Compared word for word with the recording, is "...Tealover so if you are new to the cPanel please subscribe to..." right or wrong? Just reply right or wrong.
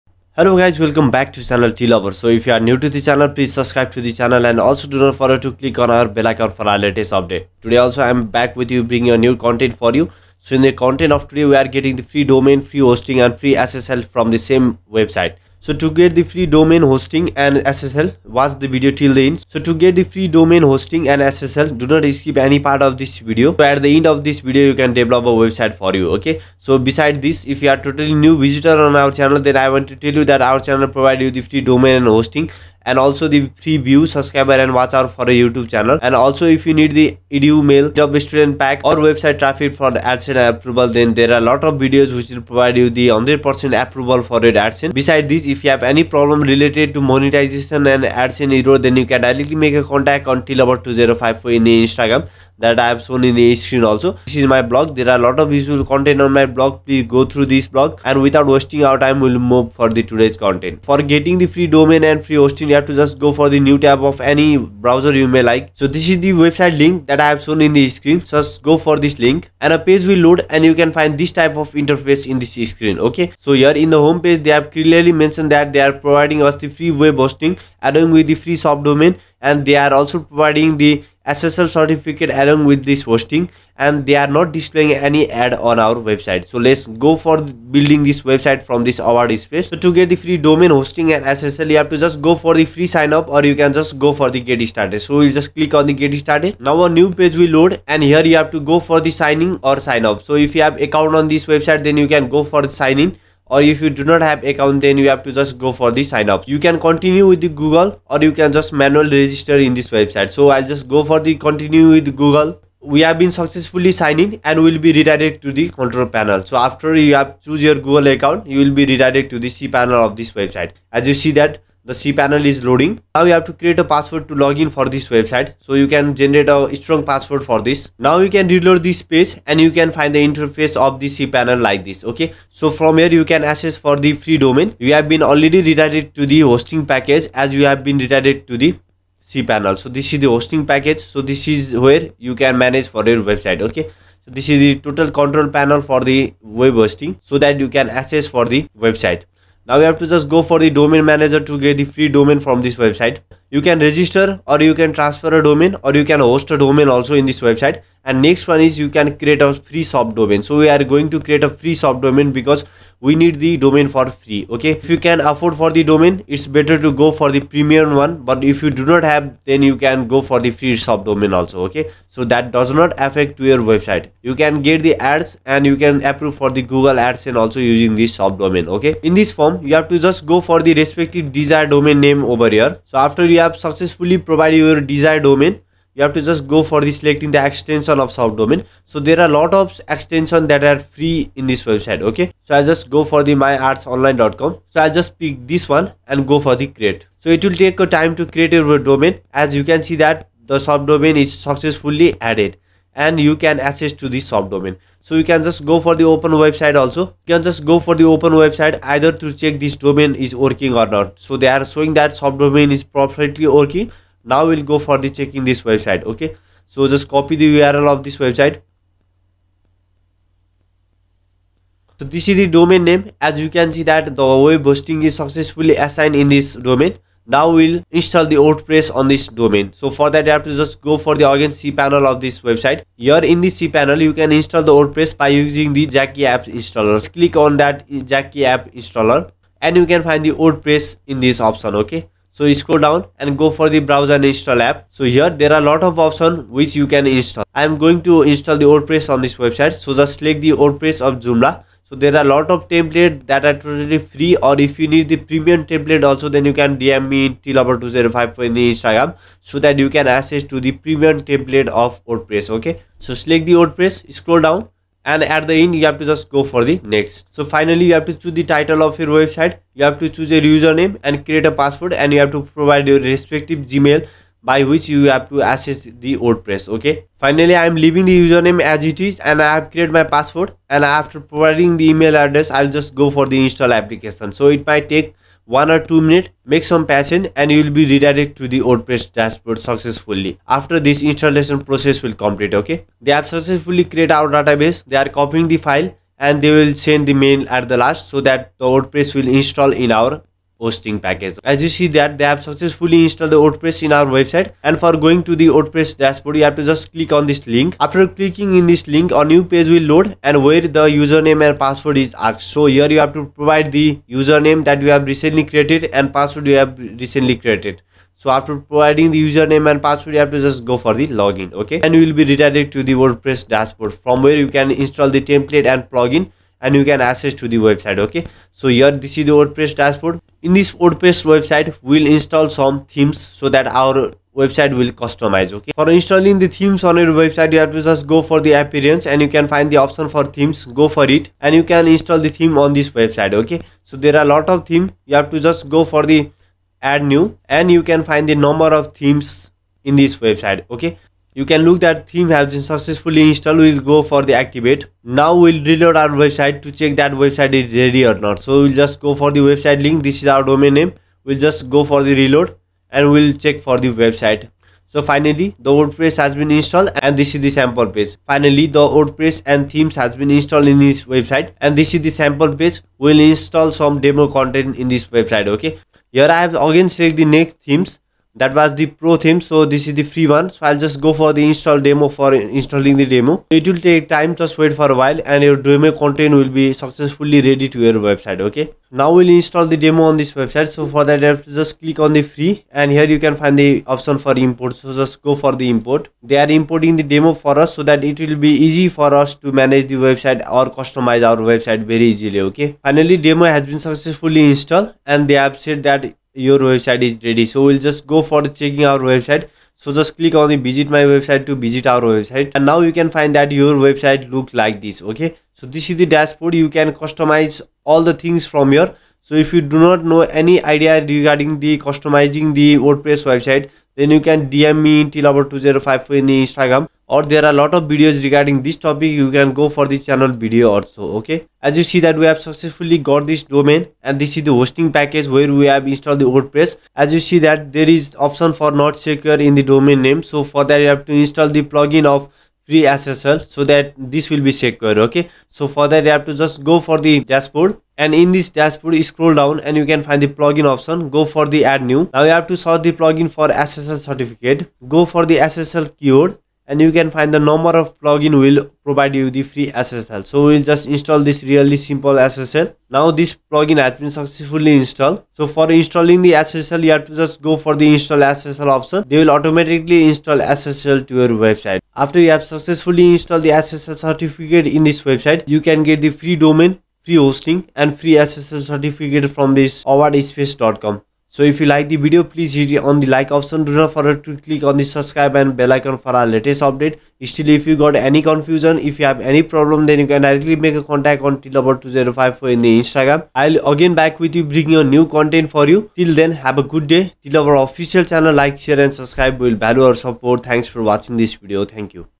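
wrong.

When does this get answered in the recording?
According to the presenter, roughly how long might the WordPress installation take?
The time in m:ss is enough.
4:45.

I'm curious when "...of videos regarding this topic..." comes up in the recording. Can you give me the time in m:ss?
7:07.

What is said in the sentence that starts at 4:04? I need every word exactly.
So here there are a lot of options which you can install.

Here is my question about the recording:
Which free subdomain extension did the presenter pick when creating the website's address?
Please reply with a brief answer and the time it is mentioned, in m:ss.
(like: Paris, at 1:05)
myartsonline.com, at 3:13.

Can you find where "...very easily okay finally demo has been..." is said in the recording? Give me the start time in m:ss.
6:41.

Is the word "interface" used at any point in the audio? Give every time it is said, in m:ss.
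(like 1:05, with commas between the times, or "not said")
1:11, 2:10.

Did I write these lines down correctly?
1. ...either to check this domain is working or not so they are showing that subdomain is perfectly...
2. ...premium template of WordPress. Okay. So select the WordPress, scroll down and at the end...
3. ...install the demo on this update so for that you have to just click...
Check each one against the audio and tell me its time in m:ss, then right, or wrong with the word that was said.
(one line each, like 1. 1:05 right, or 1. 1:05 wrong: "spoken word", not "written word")
1. 3:28 right
2. 4:20 right
3. 6:29 wrong: "website", not "update".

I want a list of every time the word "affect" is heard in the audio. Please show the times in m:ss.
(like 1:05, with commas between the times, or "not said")
2:53.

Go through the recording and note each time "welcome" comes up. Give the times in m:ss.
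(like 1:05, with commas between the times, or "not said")
0:00.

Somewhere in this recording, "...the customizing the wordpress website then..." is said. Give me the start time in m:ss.
7:01.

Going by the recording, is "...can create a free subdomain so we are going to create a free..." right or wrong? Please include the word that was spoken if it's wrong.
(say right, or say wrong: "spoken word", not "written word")
right.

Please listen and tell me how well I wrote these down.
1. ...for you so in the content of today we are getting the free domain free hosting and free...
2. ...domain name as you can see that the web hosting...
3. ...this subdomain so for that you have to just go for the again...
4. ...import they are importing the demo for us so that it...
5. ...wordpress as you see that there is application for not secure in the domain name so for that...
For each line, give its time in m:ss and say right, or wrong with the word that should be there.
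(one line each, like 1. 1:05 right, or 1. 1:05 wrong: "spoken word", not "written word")
1. 0:09 right
2. 3:42 right
3. 3:49 wrong: "domain", not "subdomain"
4. 6:35 right
5. 7:16 wrong: "option", not "application".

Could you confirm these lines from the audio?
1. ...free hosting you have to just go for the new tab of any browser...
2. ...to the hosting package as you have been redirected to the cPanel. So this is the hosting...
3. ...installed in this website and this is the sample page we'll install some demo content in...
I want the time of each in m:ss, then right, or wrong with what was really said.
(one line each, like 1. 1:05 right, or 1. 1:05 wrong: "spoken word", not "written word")
1. 1:02 right
2. 2:16 right
3. 6:10 right.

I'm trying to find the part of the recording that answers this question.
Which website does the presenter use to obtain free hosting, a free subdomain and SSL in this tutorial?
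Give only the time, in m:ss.
7:59.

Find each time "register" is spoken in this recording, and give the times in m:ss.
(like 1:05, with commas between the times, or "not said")
1:49, 2:33.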